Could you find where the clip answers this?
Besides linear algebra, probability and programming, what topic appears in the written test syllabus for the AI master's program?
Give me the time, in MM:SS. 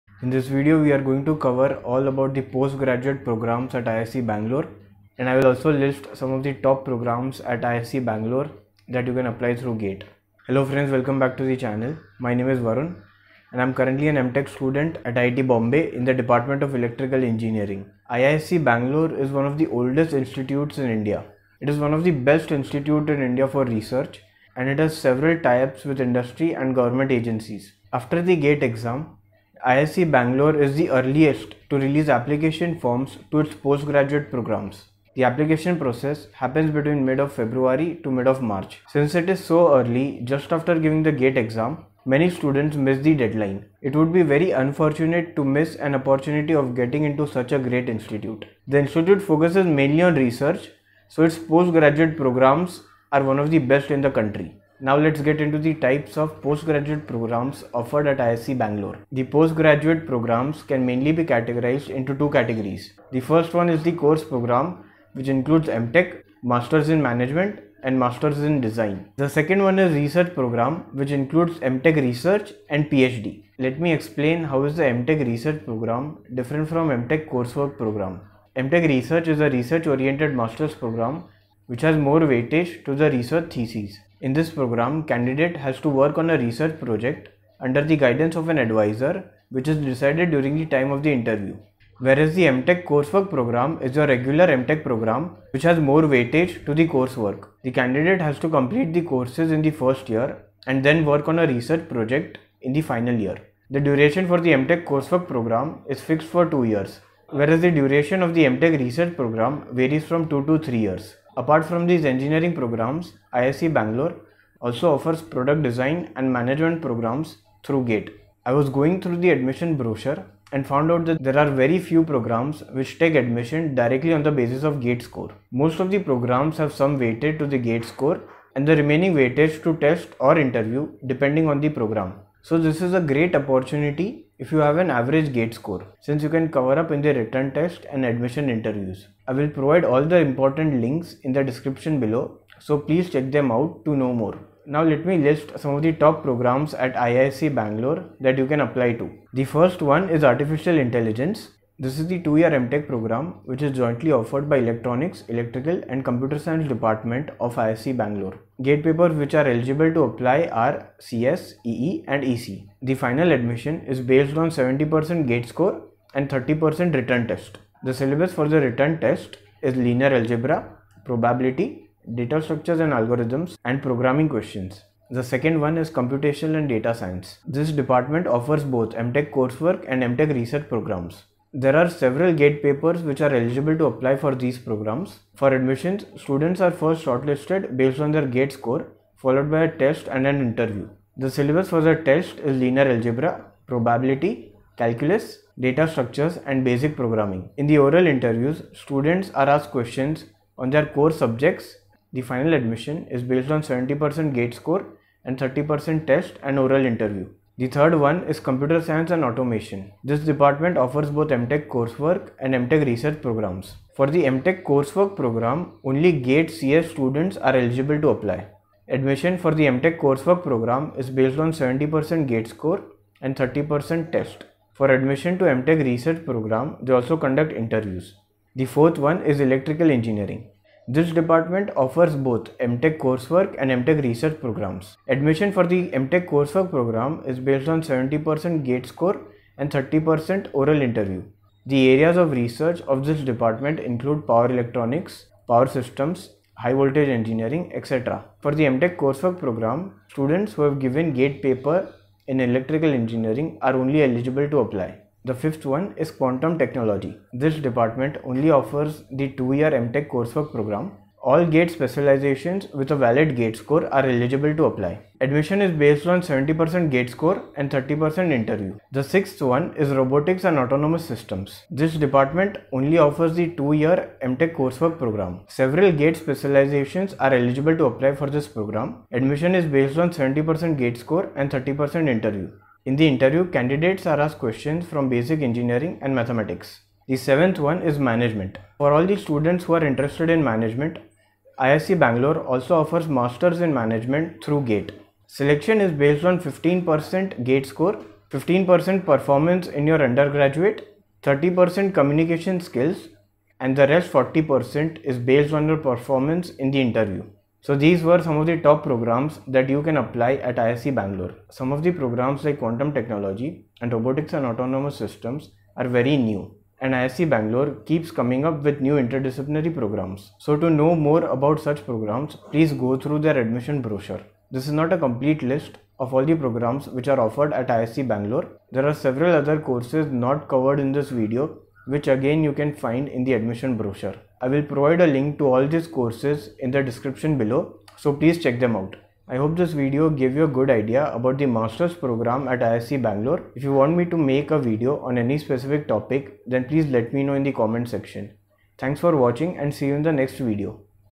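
02:52.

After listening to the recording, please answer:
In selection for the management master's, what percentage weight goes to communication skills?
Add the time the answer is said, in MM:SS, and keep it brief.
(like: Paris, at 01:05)
30%, at 05:01.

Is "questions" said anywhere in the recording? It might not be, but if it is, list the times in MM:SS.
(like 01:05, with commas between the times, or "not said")
02:54, 03:19, 04:44.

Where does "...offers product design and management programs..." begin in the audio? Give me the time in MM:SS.
01:54.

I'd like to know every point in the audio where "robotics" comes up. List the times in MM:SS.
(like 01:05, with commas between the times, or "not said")
04:29, 05:13.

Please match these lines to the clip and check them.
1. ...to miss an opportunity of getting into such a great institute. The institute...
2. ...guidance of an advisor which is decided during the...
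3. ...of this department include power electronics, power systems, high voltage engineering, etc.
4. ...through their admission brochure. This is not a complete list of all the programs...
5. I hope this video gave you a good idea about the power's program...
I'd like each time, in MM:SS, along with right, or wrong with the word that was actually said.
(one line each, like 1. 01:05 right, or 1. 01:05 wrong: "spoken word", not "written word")
1. 00:45 right
2. 01:27 right
3. 04:02 right
4. 05:22 right
5. 05:39 wrong: "master", not "power".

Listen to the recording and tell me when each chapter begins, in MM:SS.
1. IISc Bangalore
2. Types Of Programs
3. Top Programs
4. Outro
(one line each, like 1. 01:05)
1. 00:18
2. 00:54
3. 02:24
4. 05:39.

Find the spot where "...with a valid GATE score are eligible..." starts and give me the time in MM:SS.
04:22.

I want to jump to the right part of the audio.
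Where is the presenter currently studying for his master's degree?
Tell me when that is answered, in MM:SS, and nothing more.
00:15.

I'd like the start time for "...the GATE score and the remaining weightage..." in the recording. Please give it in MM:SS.
02:07.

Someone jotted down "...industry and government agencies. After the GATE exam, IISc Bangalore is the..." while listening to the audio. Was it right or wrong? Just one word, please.
right.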